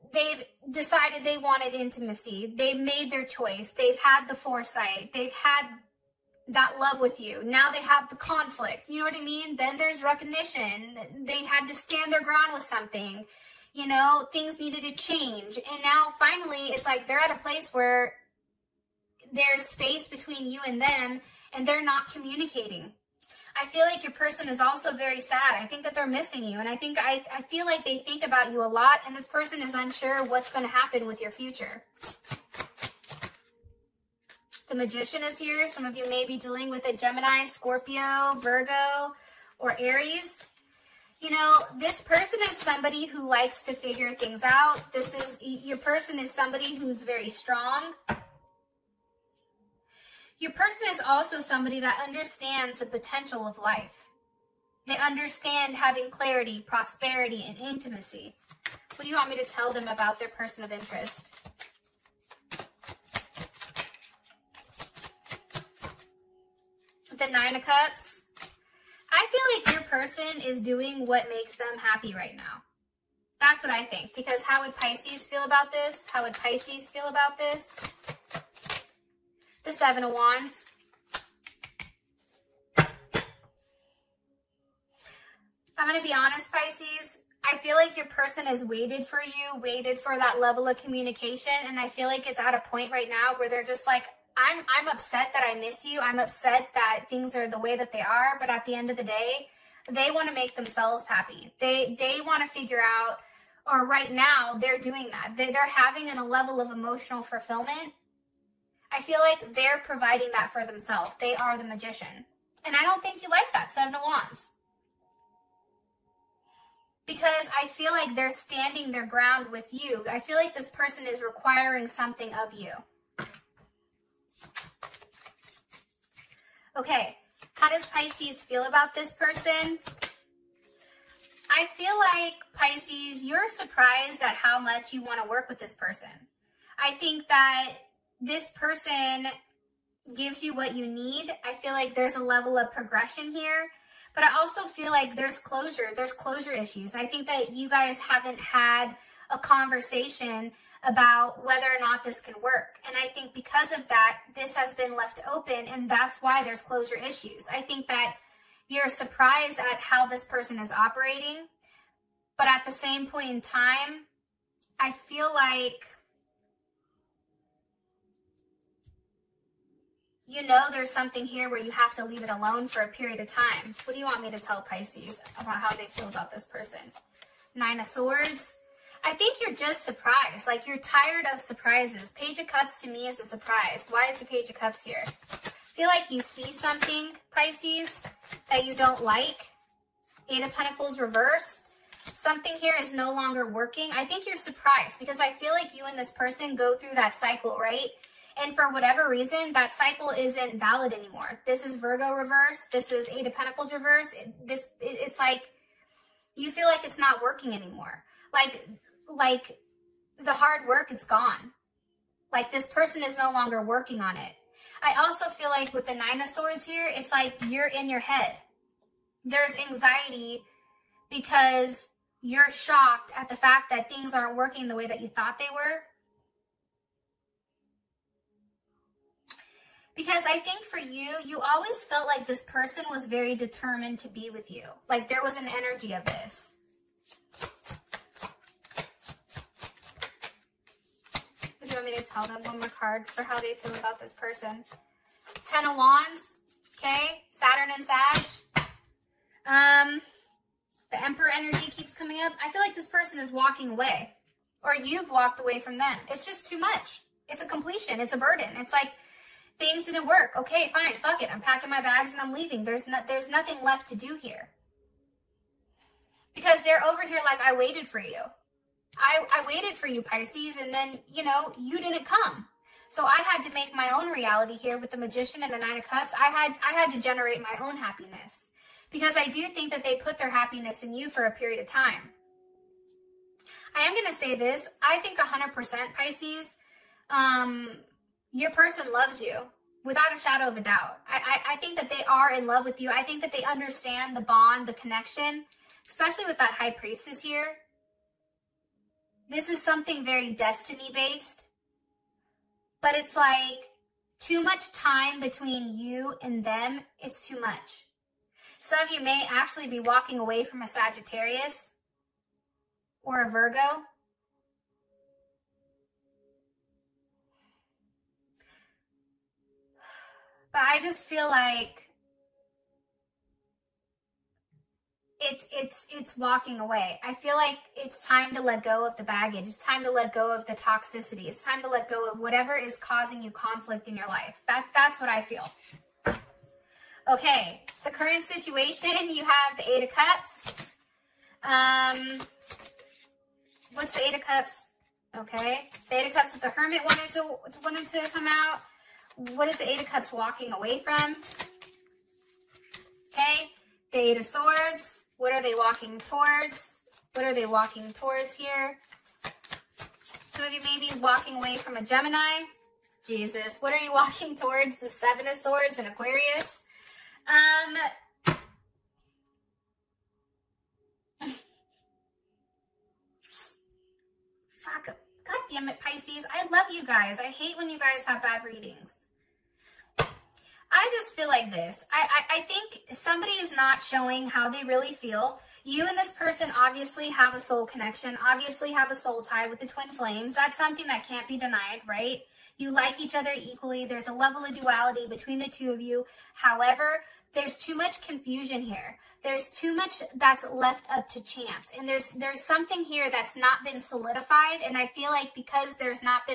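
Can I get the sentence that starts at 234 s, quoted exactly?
Like there was an energy of this.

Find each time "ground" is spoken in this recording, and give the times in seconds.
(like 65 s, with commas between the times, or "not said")
12 s, 119 s.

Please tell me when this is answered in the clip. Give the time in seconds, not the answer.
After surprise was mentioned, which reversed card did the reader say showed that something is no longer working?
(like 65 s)
190 s.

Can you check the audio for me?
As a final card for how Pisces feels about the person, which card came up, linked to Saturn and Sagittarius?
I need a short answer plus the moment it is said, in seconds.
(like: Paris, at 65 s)
Ten of Wands, at 245 s.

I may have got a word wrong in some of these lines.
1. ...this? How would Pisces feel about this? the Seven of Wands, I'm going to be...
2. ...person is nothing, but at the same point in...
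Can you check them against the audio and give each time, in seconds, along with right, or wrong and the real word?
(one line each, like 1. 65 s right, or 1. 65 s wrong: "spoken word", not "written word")
1. 75 s right
2. 160 s wrong: "operating", not "nothing".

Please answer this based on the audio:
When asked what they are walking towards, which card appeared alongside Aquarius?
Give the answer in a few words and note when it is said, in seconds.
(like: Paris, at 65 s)
Seven of Swords, at 364 s.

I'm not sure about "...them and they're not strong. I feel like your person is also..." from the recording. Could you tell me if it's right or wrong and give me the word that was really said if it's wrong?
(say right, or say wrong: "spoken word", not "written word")
wrong: "communicating", not "strong".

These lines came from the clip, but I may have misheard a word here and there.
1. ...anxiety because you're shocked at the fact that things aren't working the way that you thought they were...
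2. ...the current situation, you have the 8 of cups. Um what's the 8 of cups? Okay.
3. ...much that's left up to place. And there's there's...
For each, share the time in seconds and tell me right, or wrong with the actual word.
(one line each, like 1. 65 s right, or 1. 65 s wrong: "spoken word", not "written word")
1. 219 s right
2. 337 s right
3. 399 s wrong: "chance", not "place".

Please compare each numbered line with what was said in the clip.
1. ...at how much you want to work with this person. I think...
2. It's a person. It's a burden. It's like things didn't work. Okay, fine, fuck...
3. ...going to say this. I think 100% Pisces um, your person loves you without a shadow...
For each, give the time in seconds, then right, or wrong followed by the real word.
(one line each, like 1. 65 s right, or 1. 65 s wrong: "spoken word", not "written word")
1. 134 s right
2. 257 s wrong: "completion", not "person"
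3. 283 s right.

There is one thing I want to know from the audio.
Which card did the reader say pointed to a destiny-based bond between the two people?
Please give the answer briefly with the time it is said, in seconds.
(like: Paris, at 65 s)
High Priestess, at 296 s.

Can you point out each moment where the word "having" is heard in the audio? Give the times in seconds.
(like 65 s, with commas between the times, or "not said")
55 s, 105 s.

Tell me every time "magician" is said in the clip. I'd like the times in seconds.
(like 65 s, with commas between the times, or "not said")
34 s, 111 s, 274 s.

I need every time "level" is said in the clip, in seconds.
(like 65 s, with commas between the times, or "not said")
90 s, 106 s, 142 s, 394 s.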